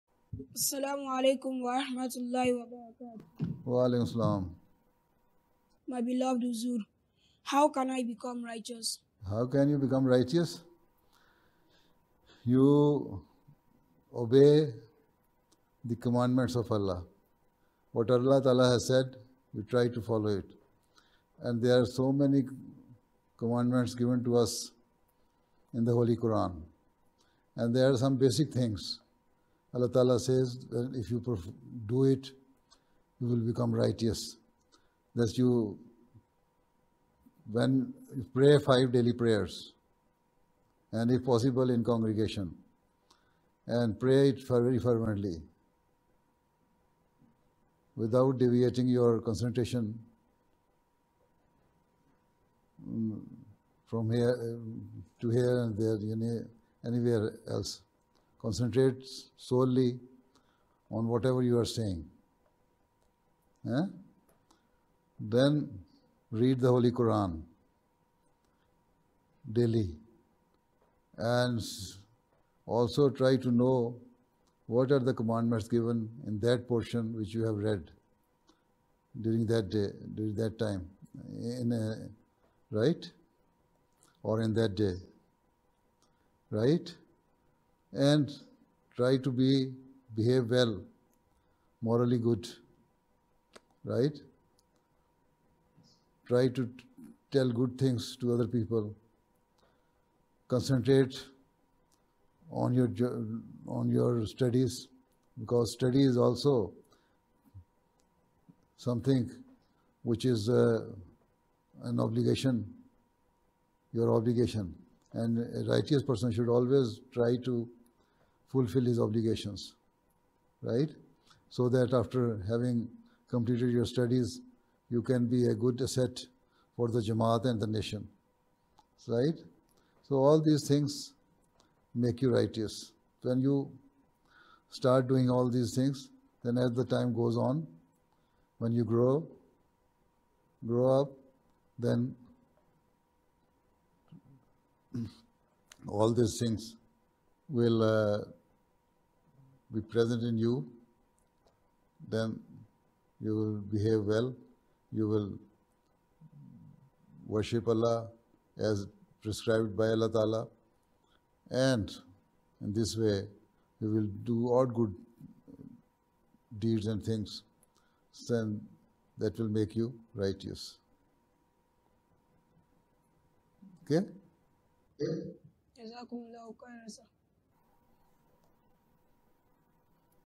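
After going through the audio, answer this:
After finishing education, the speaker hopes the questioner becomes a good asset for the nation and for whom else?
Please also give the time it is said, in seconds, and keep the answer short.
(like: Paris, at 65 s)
the Jamaat, at 126 s.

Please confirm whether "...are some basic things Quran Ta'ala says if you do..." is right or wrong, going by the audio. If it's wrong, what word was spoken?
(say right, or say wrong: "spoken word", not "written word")
wrong: "Allah", not "Quran".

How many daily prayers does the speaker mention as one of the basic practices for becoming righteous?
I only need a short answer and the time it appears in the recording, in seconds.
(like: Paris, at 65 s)
5, at 38 s.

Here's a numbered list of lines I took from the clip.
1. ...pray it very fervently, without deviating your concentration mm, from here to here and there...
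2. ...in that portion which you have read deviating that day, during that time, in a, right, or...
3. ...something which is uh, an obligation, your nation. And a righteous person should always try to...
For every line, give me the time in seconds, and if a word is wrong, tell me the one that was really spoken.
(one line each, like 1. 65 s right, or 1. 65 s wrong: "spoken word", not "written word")
1. 43 s right
2. 76 s wrong: "during", not "deviating"
3. 108 s wrong: "obligation", not "nation".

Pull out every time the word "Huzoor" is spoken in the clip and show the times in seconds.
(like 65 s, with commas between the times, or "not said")
6 s.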